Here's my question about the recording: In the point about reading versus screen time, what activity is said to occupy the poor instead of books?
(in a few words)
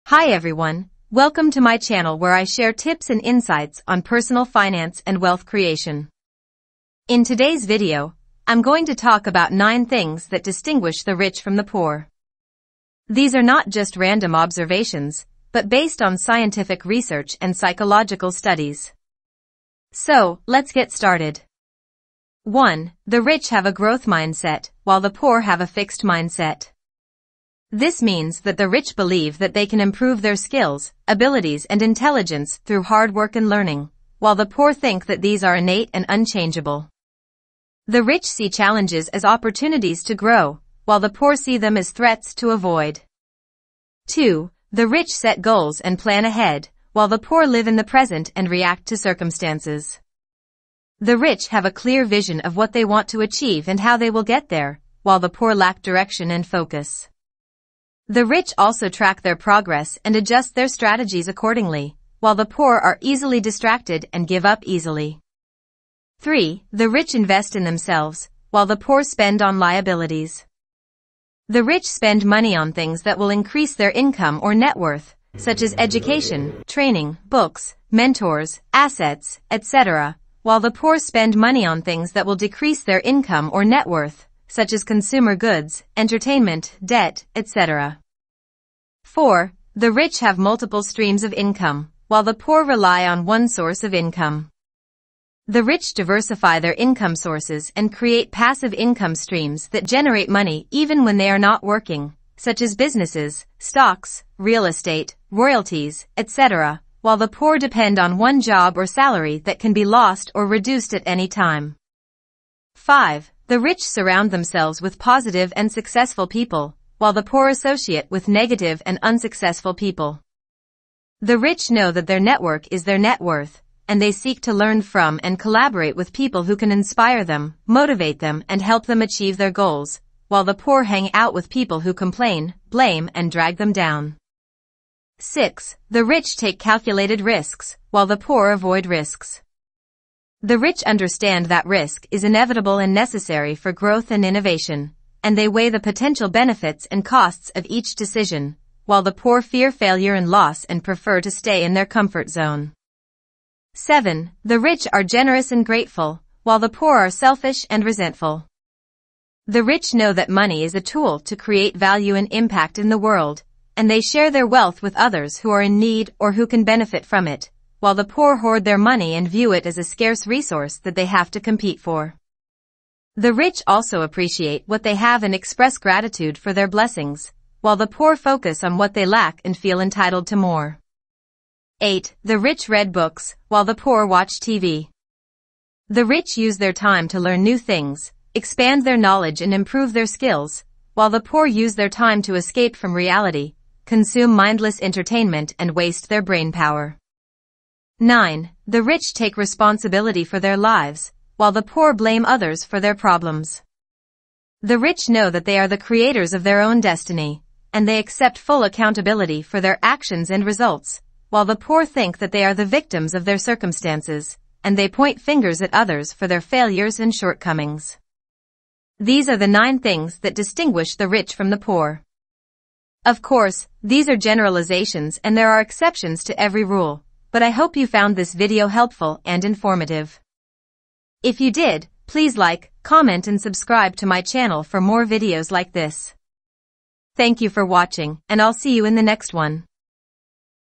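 watch TV.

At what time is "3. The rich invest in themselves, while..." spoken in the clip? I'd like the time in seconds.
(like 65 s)
66 s.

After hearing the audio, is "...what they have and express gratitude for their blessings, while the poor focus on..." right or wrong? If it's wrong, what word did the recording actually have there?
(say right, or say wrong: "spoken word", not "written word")
right.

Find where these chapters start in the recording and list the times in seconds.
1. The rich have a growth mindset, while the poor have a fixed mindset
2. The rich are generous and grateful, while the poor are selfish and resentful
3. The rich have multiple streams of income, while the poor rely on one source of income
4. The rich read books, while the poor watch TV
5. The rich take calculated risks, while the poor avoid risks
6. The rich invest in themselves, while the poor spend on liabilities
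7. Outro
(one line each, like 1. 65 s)
1. 22 s
2. 154 s
3. 89 s
4. 182 s
5. 135 s
6. 66 s
7. 219 s.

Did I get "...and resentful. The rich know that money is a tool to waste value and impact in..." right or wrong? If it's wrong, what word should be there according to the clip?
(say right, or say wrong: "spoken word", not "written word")
wrong: "create", not "waste".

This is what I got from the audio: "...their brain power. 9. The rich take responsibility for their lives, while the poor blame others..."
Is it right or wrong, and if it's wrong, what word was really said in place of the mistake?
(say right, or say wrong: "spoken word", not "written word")
right.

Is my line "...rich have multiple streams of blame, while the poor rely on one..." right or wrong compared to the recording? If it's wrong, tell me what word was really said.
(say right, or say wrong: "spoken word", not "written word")
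wrong: "income", not "blame".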